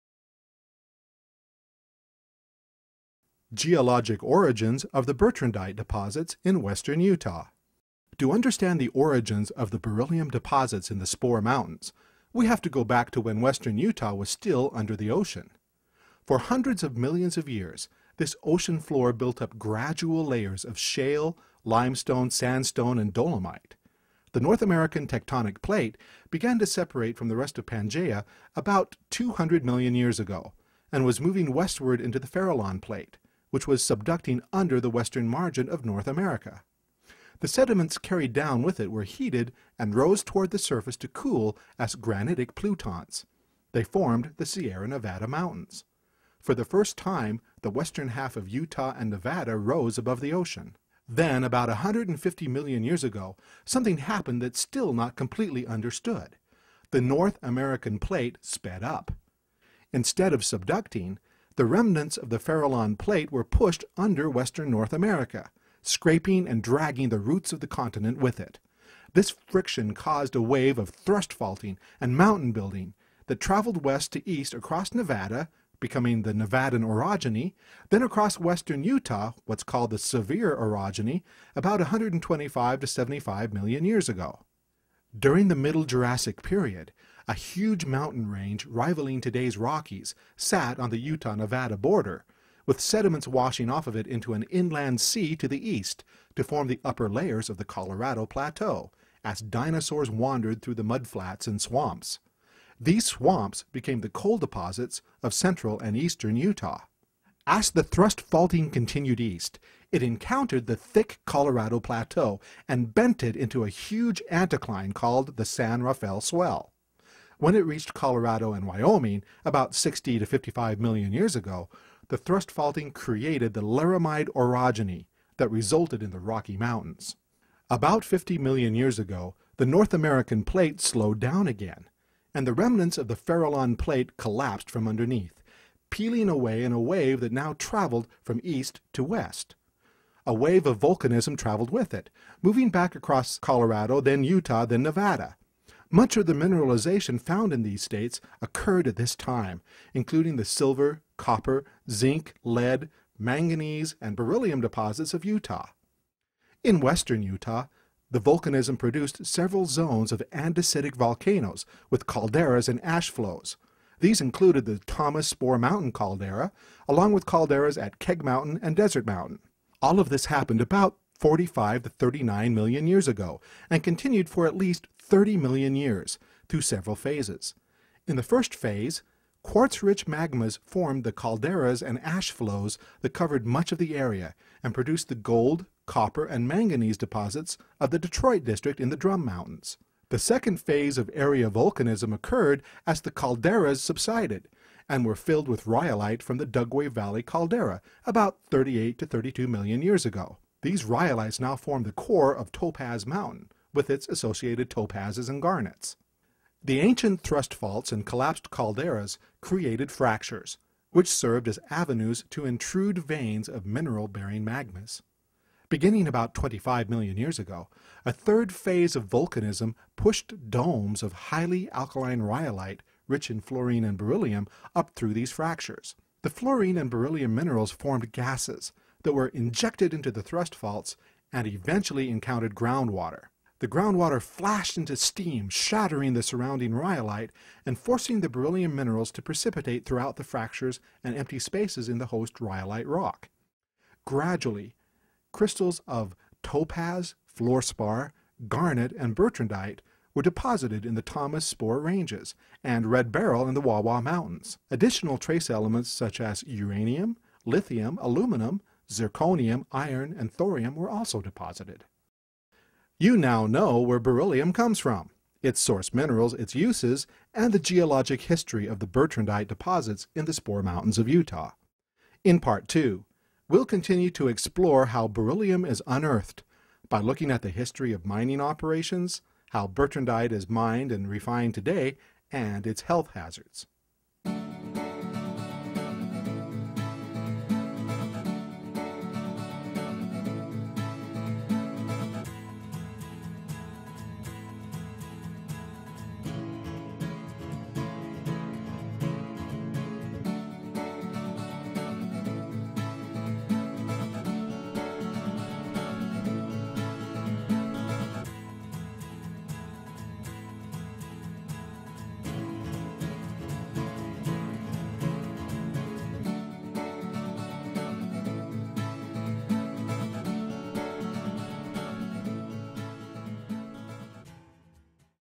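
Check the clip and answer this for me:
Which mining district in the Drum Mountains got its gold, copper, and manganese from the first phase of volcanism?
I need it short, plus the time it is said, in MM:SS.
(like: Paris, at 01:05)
Detroit district, at 03:07.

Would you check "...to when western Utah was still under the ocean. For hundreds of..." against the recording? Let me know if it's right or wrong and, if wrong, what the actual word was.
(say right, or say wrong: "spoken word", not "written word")
right.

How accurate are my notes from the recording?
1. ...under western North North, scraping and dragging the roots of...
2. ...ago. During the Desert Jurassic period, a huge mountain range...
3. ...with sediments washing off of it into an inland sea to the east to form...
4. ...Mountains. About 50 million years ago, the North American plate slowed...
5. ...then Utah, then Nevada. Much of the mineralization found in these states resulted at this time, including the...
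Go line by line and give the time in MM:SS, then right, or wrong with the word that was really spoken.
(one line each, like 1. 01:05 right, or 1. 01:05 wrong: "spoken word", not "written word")
1. 01:03 wrong: "America", not "North"
2. 01:24 wrong: "Middle", not "Desert"
3. 01:32 right
4. 02:06 right
5. 02:24 wrong: "occurred", not "resulted".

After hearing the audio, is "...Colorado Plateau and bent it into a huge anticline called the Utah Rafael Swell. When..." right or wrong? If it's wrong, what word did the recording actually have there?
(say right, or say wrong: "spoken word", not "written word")
wrong: "San", not "Utah".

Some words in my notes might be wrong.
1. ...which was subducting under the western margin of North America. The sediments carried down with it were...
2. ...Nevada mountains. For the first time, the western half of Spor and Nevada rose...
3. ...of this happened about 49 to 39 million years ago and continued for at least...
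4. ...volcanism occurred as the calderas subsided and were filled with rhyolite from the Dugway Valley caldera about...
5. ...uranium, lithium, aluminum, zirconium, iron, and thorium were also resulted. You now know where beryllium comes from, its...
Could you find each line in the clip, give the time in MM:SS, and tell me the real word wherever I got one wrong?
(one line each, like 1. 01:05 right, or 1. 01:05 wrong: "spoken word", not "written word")
1. 00:33 right
2. 00:44 wrong: "Utah", not "Spor"
3. 02:49 wrong: "45", not "49"
4. 03:11 right
5. 04:16 wrong: "deposited", not "resulted".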